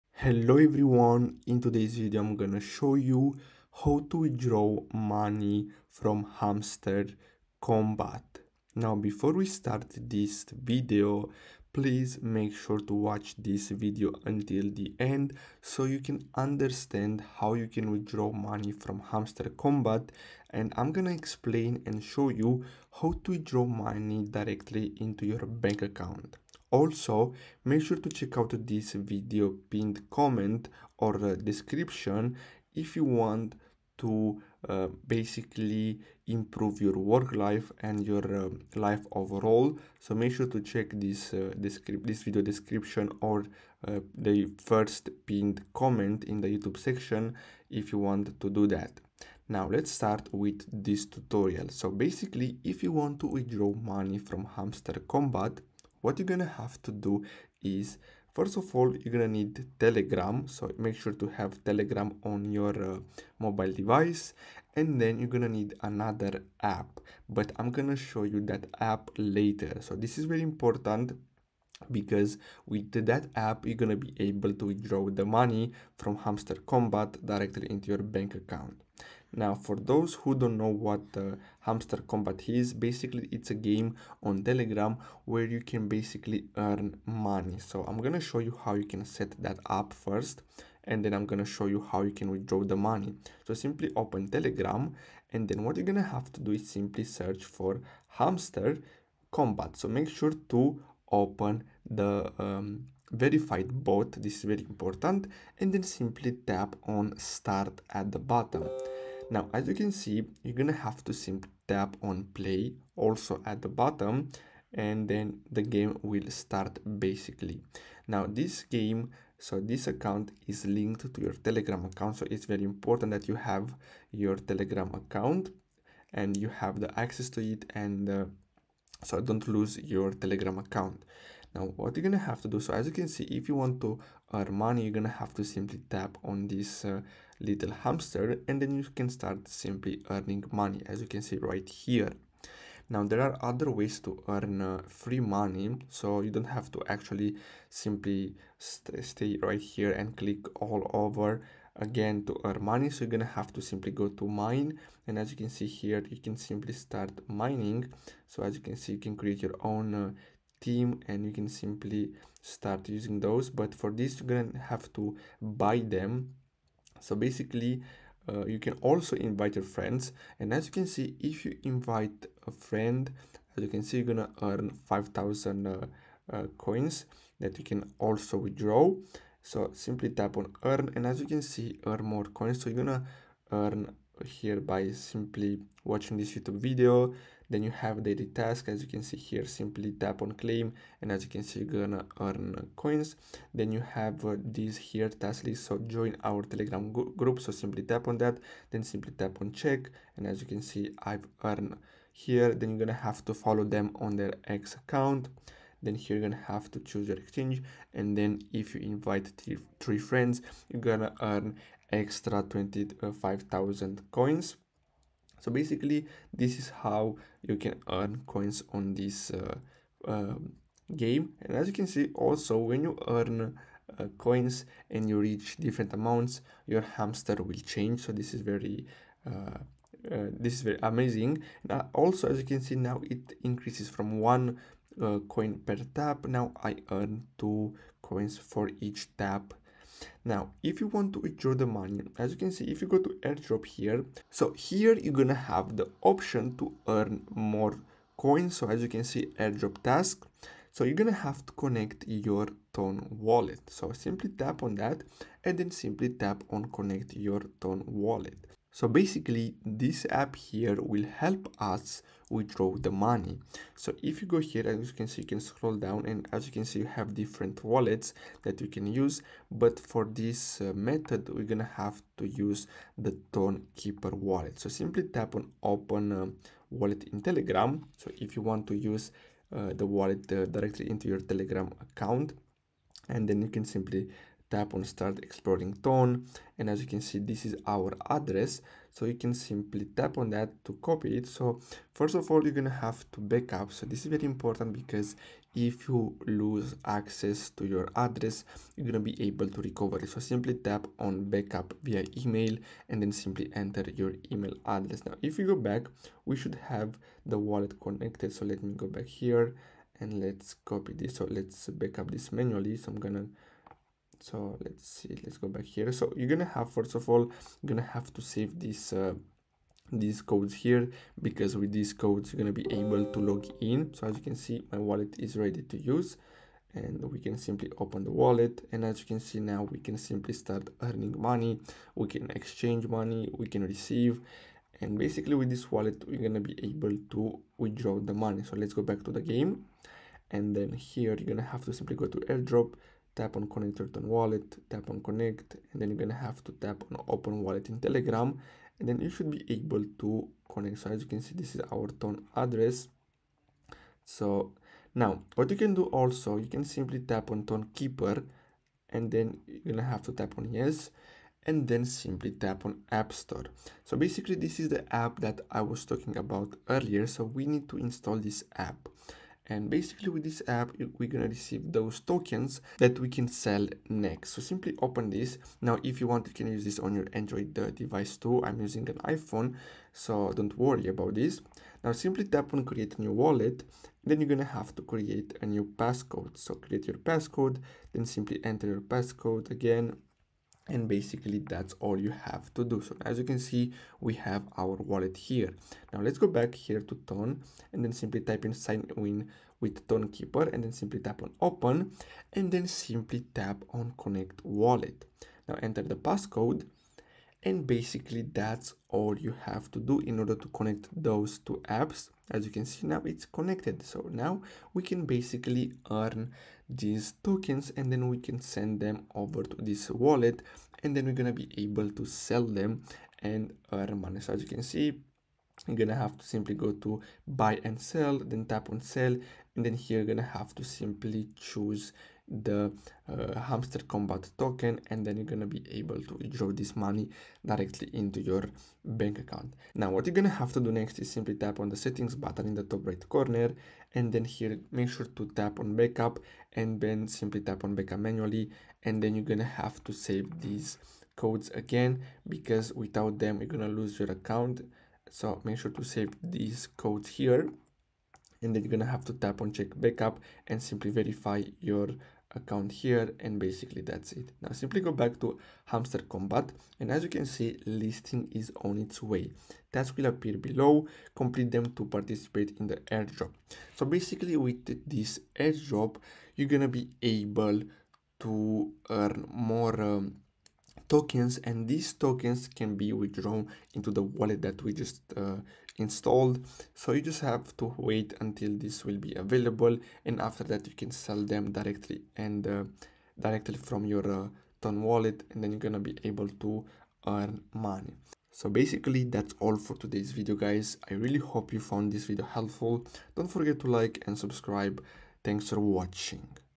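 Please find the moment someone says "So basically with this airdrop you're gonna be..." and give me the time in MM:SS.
07:53.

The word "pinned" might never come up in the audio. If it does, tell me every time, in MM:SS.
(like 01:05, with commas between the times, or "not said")
00:29, 00:45.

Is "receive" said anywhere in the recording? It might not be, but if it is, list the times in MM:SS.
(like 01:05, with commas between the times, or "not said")
05:33, 06:11.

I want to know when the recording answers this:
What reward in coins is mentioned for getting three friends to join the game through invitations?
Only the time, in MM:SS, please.
03:32.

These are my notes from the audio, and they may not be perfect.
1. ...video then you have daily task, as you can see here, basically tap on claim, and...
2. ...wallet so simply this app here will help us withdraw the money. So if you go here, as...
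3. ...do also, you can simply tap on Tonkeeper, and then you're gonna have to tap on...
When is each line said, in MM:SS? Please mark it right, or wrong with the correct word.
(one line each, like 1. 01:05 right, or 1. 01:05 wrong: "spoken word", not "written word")
1. 03:06 wrong: "simply", not "basically"
2. 04:17 wrong: "basically", not "simply"
3. 05:55 right.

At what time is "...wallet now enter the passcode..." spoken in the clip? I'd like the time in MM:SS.
06:44.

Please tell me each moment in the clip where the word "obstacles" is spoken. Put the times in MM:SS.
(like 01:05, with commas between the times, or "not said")
not said.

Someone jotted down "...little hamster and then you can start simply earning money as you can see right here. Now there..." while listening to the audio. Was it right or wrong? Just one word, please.
right.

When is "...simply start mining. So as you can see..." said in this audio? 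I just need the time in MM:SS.
02:36.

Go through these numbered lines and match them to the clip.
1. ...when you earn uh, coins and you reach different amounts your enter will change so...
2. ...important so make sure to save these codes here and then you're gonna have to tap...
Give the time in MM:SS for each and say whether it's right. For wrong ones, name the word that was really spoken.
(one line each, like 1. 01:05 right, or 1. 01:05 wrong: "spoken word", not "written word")
1. 03:42 wrong: "hamster", not "enter"
2. 07:34 wrong: "account", not "important".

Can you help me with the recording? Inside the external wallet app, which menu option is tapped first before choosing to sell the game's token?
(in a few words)
buy and sell.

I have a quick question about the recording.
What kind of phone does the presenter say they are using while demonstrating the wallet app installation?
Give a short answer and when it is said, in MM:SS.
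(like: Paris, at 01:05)
iPhone, at 06:19.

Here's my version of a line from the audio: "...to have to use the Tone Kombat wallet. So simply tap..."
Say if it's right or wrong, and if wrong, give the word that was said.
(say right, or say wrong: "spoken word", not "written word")
wrong: "Keeper", not "Kombat".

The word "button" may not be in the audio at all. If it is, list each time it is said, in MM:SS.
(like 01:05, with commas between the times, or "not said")
07:22.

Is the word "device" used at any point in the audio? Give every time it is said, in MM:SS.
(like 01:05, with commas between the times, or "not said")
01:03, 06:17.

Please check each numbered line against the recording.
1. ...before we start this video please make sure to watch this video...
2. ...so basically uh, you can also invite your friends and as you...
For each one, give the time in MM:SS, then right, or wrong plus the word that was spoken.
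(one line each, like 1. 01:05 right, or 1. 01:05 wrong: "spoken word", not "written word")
1. 00:08 right
2. 02:47 right.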